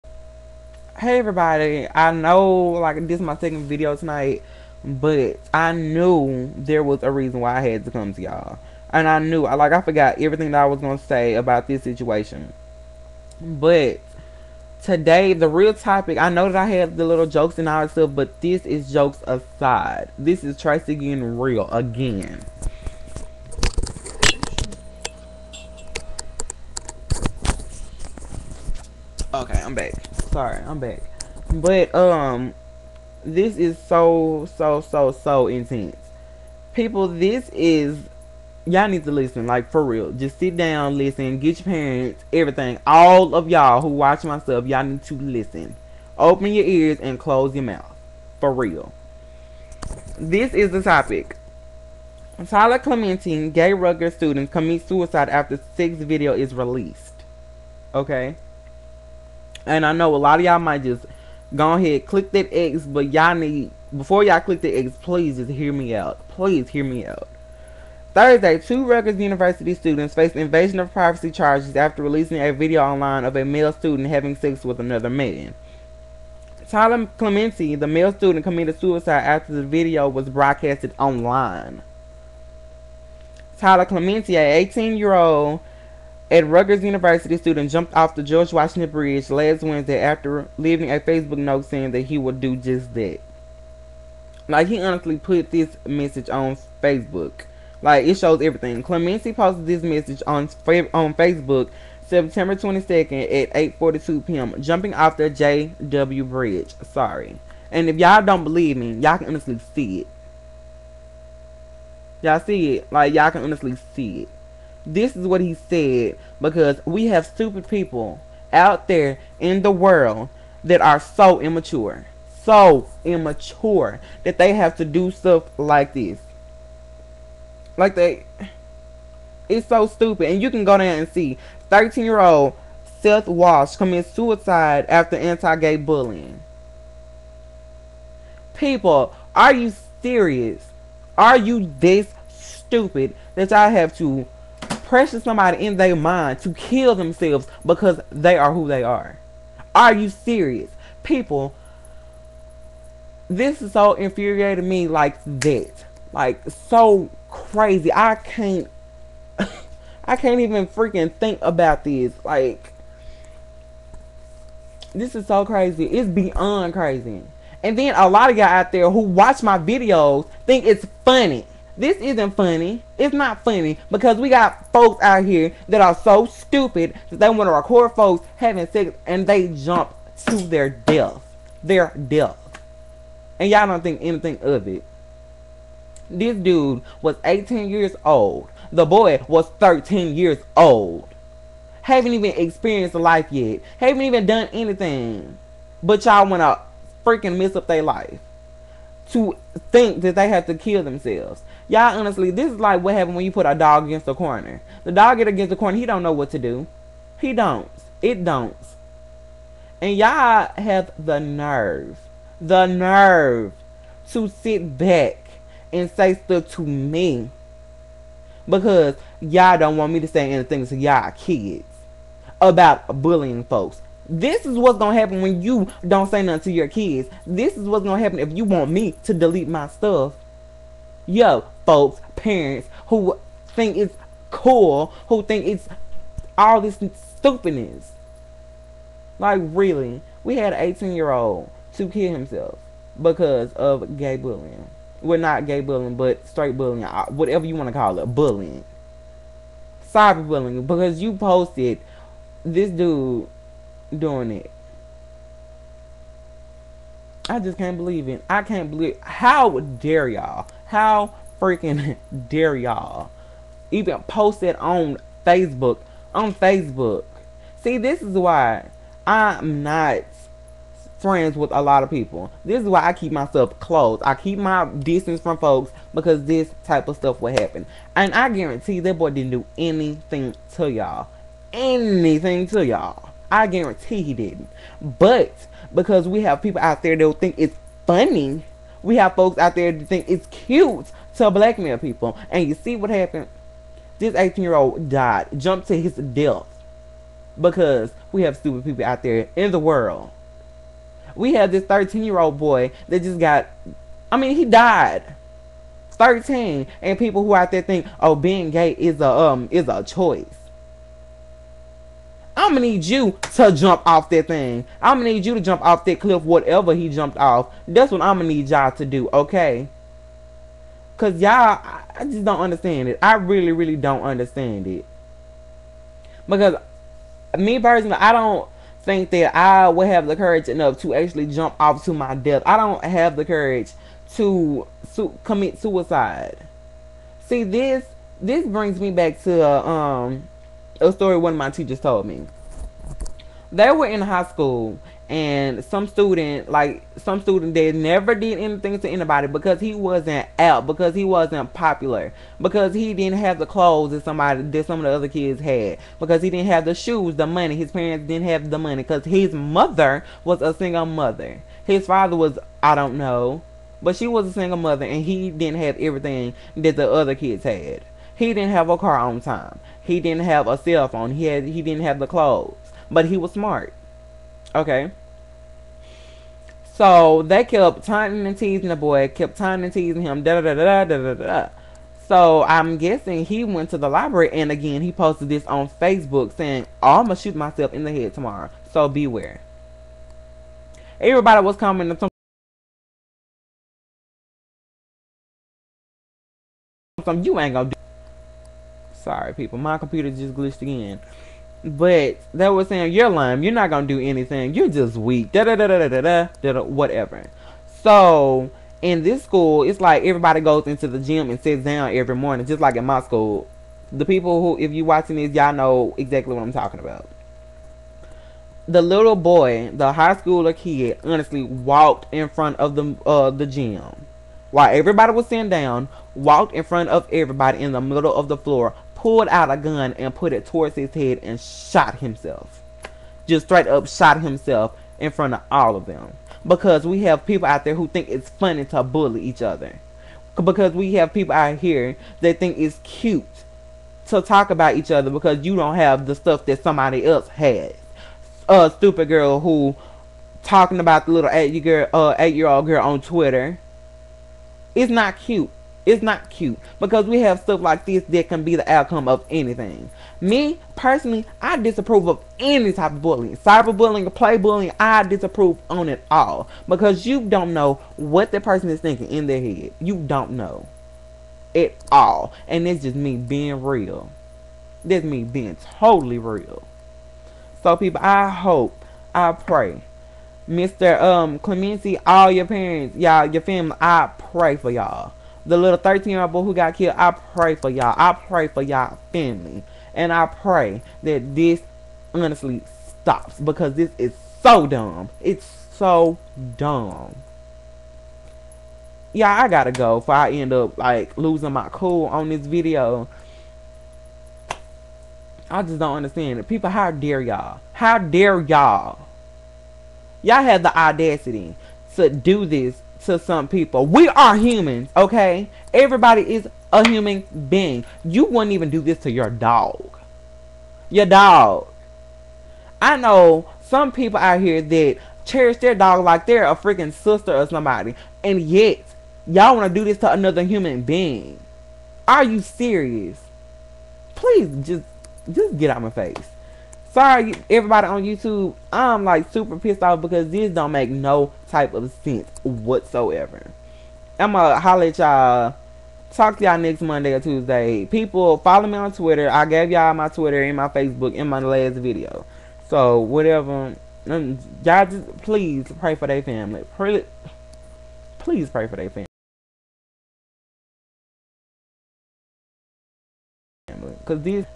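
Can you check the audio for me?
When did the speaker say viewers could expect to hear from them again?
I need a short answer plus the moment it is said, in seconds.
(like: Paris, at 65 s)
Next Monday or Tuesday, at 546 s.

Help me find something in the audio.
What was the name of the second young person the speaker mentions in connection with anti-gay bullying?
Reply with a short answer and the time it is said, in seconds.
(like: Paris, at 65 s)
Seth Walsh, at 133 s.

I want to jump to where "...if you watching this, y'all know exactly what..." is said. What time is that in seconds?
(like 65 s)
414 s.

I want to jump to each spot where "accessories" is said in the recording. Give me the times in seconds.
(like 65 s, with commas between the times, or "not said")
not said.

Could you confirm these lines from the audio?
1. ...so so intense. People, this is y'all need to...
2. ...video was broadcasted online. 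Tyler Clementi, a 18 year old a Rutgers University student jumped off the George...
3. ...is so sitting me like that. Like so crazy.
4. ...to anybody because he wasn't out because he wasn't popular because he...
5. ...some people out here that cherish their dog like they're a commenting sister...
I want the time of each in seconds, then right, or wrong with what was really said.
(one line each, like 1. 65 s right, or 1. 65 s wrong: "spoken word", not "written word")
1. 34 s right
2. 79 s right
3. 153 s wrong: "infuriating", not "sitting"
4. 348 s right
5. 523 s wrong: "freaking", not "commenting".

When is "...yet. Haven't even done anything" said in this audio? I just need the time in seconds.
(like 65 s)
193 s.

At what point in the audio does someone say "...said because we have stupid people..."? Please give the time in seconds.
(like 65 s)
115 s.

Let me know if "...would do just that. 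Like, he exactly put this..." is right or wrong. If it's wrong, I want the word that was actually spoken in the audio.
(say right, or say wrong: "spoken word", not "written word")
wrong: "honestly", not "exactly".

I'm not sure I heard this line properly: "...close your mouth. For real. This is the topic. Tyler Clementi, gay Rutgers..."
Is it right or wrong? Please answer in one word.
right.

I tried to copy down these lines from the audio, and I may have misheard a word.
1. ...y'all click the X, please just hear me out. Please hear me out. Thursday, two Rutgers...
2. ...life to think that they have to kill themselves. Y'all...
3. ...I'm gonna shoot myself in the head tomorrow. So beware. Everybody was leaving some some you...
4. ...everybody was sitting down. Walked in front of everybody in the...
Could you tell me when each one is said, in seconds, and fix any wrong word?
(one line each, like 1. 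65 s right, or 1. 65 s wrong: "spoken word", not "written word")
1. 64 s right
2. 197 s right
3. 386 s wrong: "commenting", not "leaving"
4. 424 s right.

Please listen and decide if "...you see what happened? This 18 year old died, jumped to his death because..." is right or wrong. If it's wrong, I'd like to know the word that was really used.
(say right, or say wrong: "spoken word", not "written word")
right.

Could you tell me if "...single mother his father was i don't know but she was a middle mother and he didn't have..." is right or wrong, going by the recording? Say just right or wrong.
wrong.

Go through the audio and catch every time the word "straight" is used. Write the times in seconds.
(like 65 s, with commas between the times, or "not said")
246 s, 433 s.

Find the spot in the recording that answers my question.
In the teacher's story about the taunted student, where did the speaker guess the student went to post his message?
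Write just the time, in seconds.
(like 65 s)
383 s.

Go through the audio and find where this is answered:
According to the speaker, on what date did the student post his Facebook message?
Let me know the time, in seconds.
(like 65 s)
102 s.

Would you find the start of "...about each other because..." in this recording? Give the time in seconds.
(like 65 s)
444 s.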